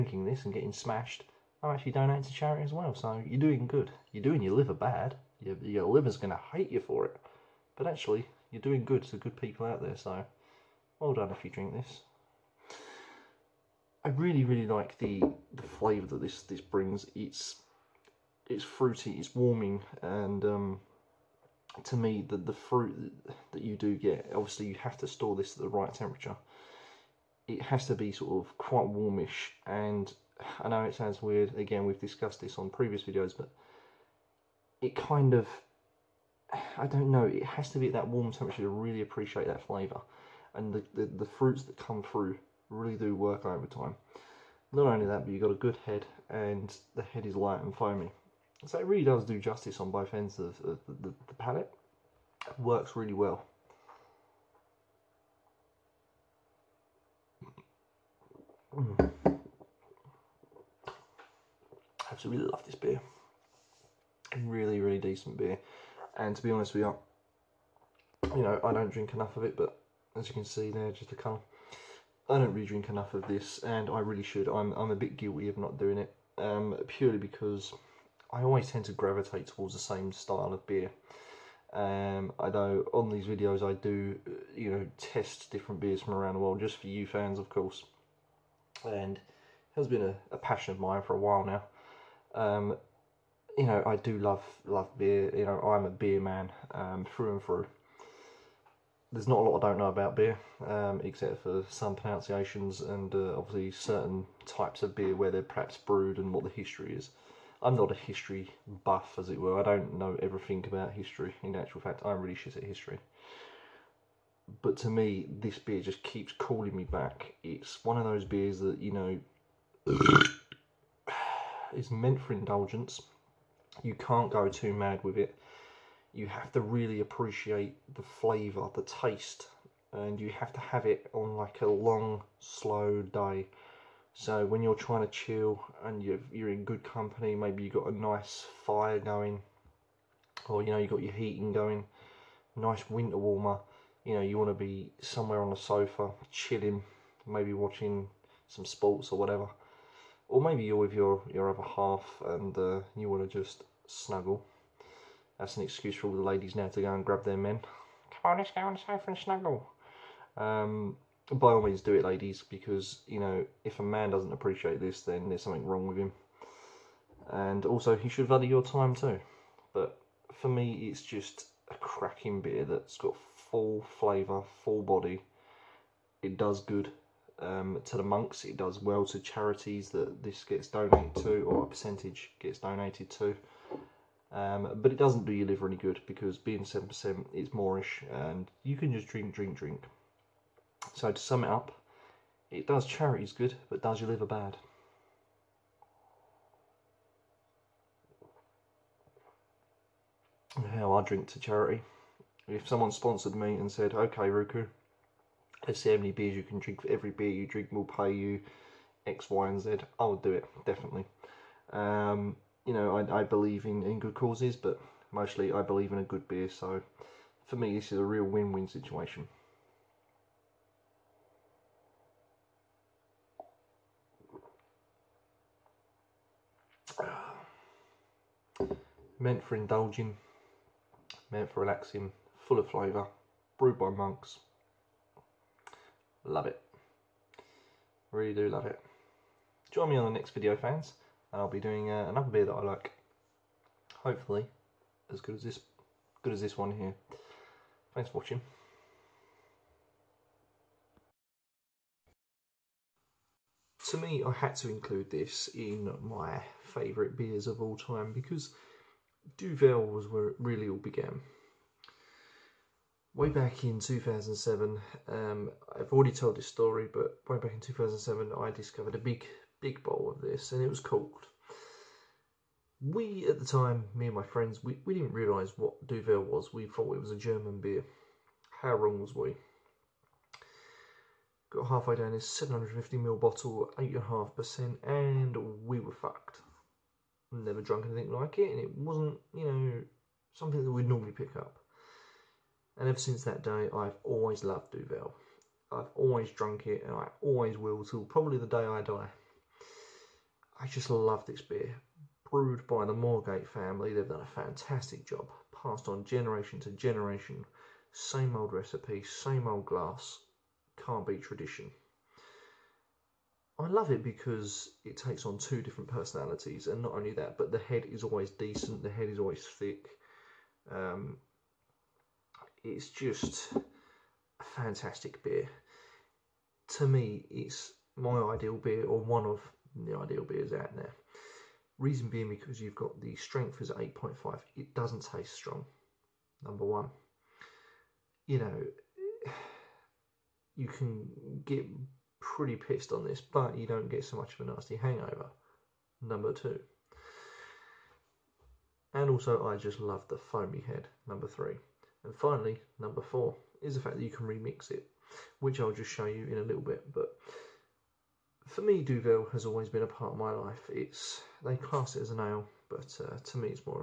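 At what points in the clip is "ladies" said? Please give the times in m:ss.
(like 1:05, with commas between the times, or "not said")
2:36, 2:42.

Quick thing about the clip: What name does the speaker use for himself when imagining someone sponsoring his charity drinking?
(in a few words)
Ruku.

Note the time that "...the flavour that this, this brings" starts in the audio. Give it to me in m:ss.
0:15.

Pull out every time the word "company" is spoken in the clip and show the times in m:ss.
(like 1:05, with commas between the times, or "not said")
2:16.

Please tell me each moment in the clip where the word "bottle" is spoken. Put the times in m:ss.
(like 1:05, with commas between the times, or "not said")
4:43.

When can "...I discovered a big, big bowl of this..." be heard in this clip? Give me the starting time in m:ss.
4:28.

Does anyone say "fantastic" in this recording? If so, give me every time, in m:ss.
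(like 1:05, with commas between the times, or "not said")
5:04, 5:24.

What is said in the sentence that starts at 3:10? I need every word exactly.
So to sum it up, it does charities good, but does your liver bad.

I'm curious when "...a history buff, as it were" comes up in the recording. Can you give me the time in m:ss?
1:47.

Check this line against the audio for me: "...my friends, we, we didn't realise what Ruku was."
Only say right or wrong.
wrong.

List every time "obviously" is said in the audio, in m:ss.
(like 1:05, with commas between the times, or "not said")
0:24, 1:43.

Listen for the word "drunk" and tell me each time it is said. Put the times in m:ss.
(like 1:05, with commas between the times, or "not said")
4:47, 4:56.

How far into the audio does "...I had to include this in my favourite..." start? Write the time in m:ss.
4:14.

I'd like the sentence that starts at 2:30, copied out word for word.
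Or maybe you're with your, your other half and uh, you want to just snuggle.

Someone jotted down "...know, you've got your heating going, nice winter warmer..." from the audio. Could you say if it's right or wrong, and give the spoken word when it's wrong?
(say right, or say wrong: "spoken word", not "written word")
right.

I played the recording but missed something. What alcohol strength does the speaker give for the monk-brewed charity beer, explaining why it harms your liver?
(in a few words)
7%.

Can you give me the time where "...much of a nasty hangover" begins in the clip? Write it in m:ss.
5:44.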